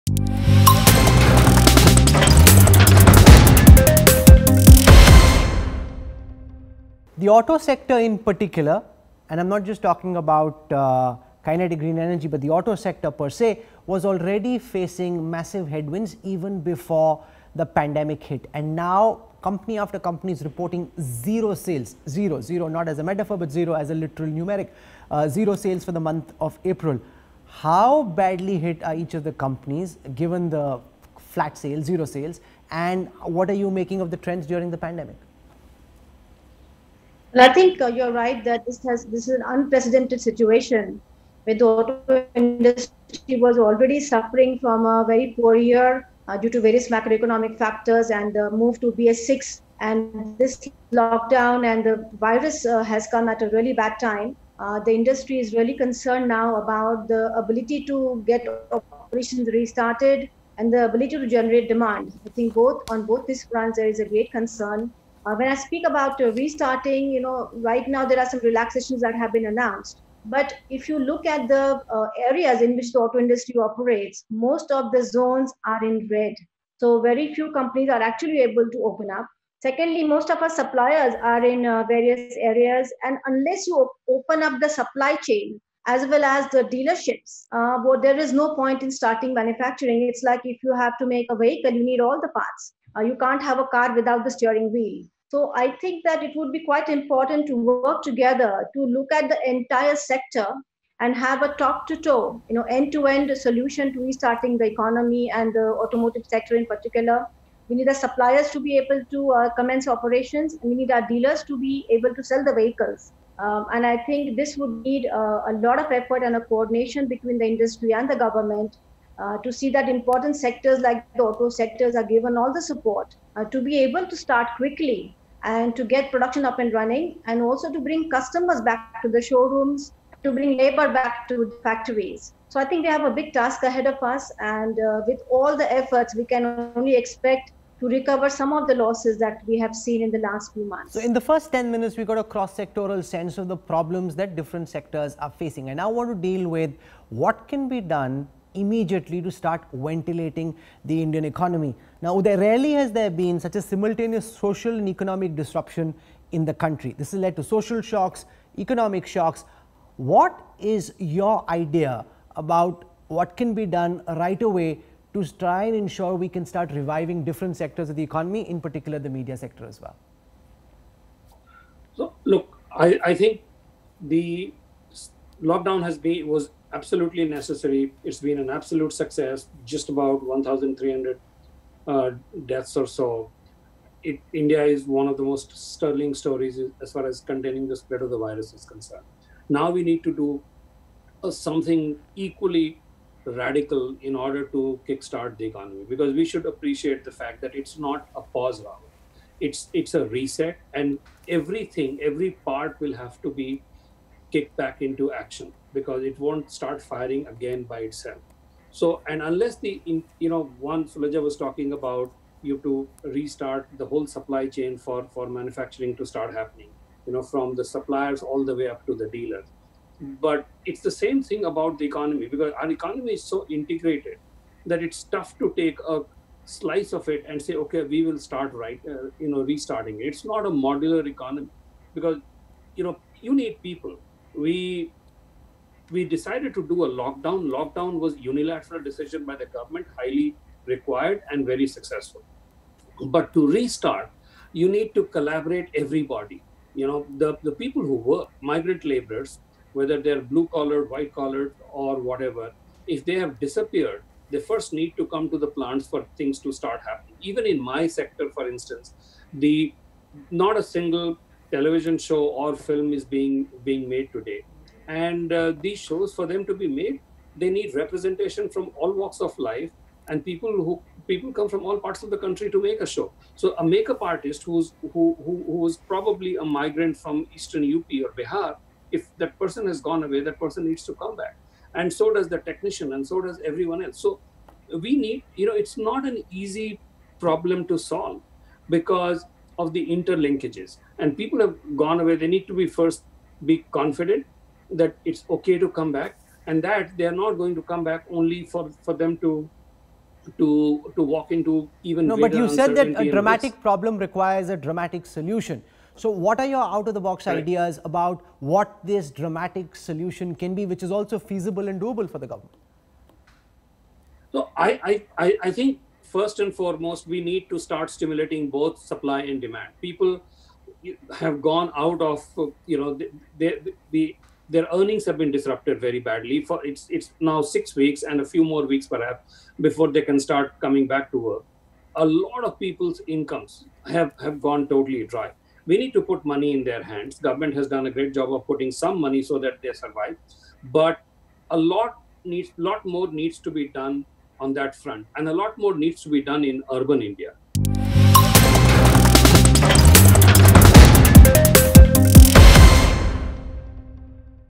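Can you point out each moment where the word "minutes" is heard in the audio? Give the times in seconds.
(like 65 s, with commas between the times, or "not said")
141 s.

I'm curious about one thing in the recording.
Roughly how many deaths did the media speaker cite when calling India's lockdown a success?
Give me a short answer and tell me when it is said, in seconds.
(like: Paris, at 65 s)
1,300, at 180 s.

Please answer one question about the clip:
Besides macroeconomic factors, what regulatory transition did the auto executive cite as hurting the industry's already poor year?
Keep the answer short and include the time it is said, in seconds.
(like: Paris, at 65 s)
BS6, at 48 s.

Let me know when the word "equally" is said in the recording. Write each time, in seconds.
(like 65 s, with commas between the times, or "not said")
192 s.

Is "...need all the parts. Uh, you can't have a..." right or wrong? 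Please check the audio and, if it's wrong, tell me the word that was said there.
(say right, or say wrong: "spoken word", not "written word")
right.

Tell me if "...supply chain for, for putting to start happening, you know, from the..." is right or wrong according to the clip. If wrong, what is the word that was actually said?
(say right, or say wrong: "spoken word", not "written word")
wrong: "manufacturing", not "putting".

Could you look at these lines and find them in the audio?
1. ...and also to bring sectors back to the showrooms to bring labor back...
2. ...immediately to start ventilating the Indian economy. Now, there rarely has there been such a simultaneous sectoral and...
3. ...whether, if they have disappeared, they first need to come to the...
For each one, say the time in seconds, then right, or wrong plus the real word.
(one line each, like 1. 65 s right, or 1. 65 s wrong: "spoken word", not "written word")
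1. 127 s wrong: "customers", not "sectors"
2. 148 s wrong: "social", not "sectoral"
3. 251 s wrong: "whatever", not "whether".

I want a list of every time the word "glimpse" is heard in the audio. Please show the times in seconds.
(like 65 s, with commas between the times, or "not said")
not said.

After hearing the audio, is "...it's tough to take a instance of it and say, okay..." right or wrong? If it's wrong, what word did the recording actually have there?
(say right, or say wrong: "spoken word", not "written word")
wrong: "slice", not "instance".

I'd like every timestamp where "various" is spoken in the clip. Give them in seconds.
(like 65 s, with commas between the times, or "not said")
46 s, 81 s.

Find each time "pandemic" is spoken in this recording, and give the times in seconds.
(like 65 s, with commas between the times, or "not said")
17 s, 34 s.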